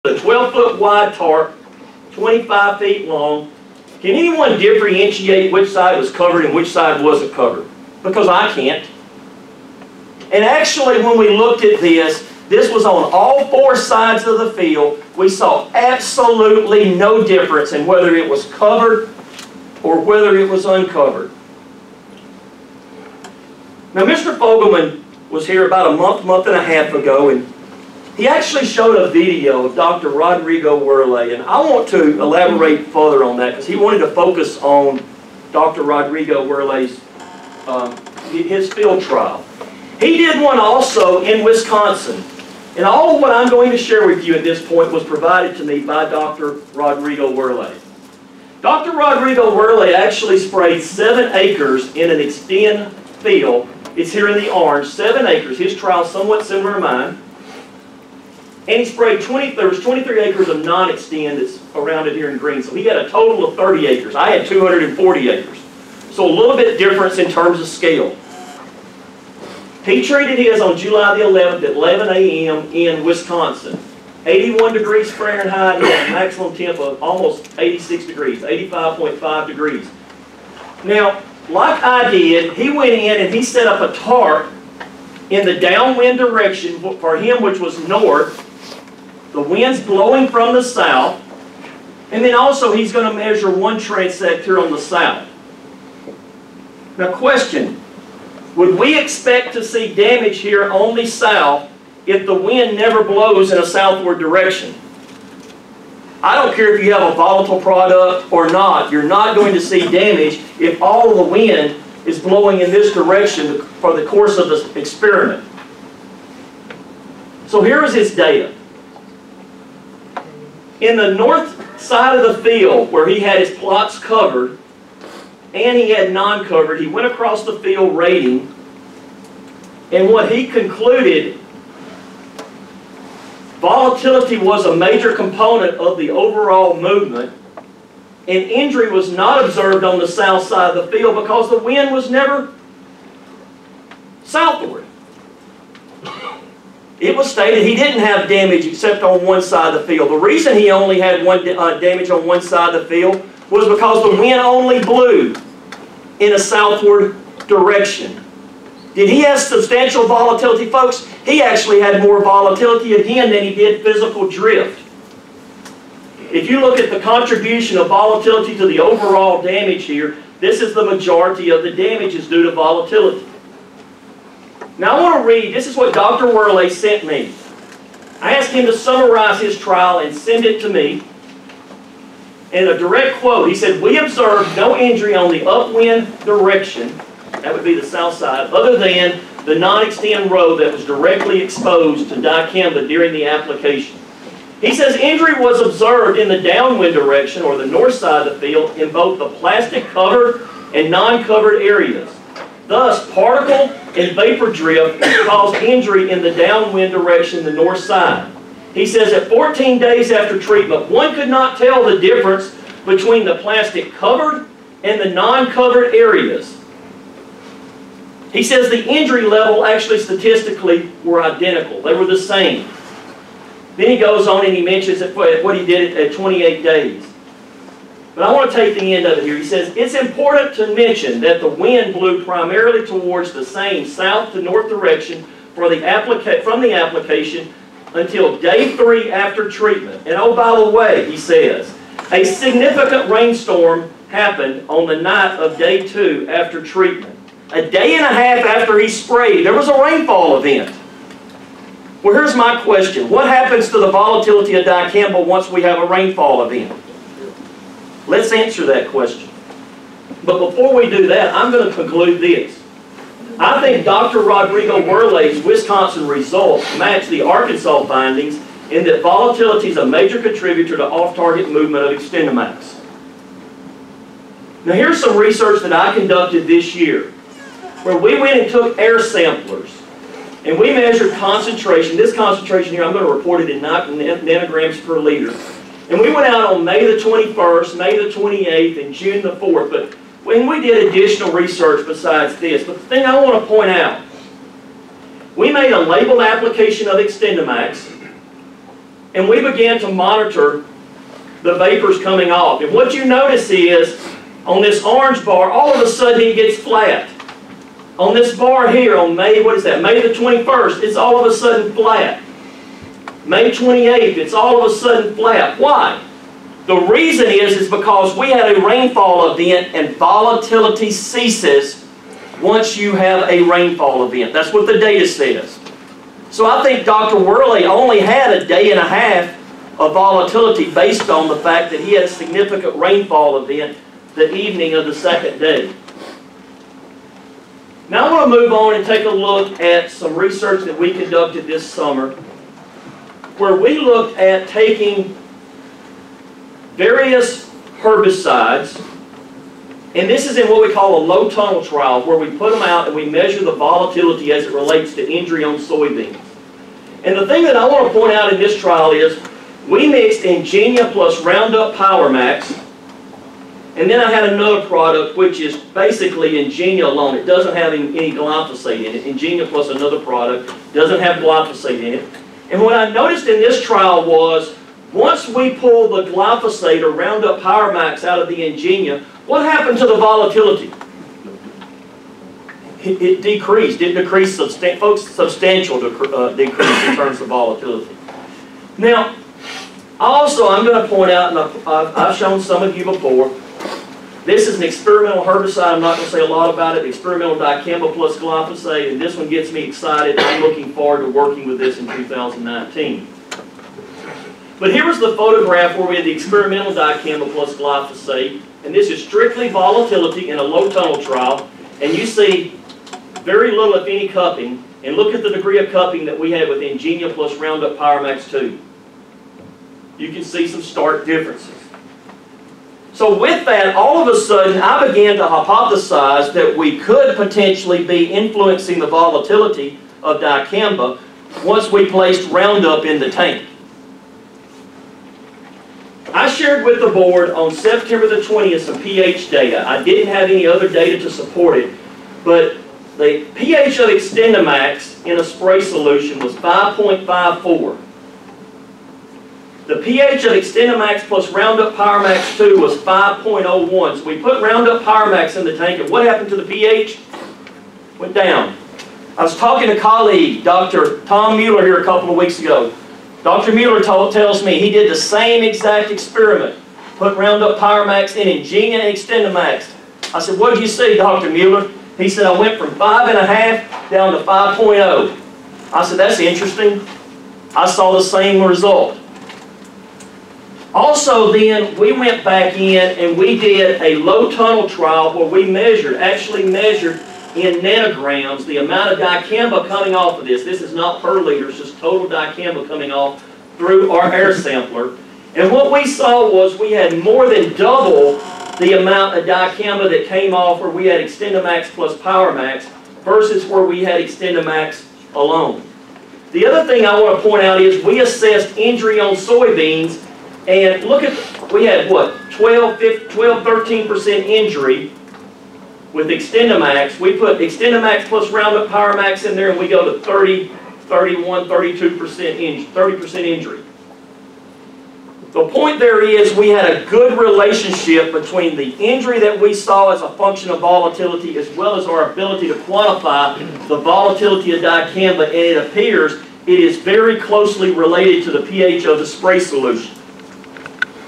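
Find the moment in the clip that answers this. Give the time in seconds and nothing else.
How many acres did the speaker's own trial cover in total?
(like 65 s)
64 s.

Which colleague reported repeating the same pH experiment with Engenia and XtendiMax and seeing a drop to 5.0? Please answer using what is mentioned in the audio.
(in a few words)
Dr. Tom Mueller.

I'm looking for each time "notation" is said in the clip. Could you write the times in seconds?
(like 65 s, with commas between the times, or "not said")
not said.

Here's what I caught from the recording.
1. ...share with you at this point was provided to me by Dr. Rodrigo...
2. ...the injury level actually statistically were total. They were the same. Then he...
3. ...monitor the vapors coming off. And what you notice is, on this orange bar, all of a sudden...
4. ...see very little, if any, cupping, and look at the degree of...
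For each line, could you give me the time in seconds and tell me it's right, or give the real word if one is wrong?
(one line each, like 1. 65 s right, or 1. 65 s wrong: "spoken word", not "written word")
1. 43 s right
2. 218 s wrong: "identical", not "total"
3. 299 s right
4. 412 s right.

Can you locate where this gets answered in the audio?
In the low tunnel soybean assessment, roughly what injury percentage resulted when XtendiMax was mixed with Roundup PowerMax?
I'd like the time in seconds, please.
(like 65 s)
522 s.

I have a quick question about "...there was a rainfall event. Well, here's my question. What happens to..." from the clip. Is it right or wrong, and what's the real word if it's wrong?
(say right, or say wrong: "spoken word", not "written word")
right.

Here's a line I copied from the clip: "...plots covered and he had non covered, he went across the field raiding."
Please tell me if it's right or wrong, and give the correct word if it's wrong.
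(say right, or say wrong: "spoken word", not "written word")
right.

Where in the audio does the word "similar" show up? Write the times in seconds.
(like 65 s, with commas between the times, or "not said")
56 s.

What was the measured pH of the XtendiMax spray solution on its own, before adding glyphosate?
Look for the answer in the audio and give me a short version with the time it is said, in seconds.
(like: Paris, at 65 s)
5.54, at 446 s.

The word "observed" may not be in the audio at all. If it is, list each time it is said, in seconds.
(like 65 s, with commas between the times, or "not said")
139 s, 183 s, 195 s.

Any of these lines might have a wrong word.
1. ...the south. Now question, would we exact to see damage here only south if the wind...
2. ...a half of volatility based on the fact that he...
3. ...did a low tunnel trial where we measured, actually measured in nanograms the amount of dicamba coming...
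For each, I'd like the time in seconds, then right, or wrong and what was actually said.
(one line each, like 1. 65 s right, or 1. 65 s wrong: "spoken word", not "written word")
1. 94 s wrong: "expect", not "exact"
2. 328 s right
3. 483 s right.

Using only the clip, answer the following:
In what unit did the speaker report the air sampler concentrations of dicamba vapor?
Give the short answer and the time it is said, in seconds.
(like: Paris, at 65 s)
Nanograms per liter, at 283 s.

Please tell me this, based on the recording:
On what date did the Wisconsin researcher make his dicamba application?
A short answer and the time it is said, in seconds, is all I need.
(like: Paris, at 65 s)
July 11, at 70 s.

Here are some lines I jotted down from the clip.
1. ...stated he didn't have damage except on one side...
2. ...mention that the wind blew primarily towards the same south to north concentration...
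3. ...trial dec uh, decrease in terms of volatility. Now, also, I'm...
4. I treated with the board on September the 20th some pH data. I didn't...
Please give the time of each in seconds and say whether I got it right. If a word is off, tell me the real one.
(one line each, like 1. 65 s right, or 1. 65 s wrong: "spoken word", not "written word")
1. 147 s right
2. 230 s wrong: "direction", not "concentration"
3. 385 s wrong: "substantial", not "trial"
4. 436 s wrong: "shared", not "treated".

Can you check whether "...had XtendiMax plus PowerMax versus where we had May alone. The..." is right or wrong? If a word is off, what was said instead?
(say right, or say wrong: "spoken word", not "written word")
wrong: "XtendiMax", not "May".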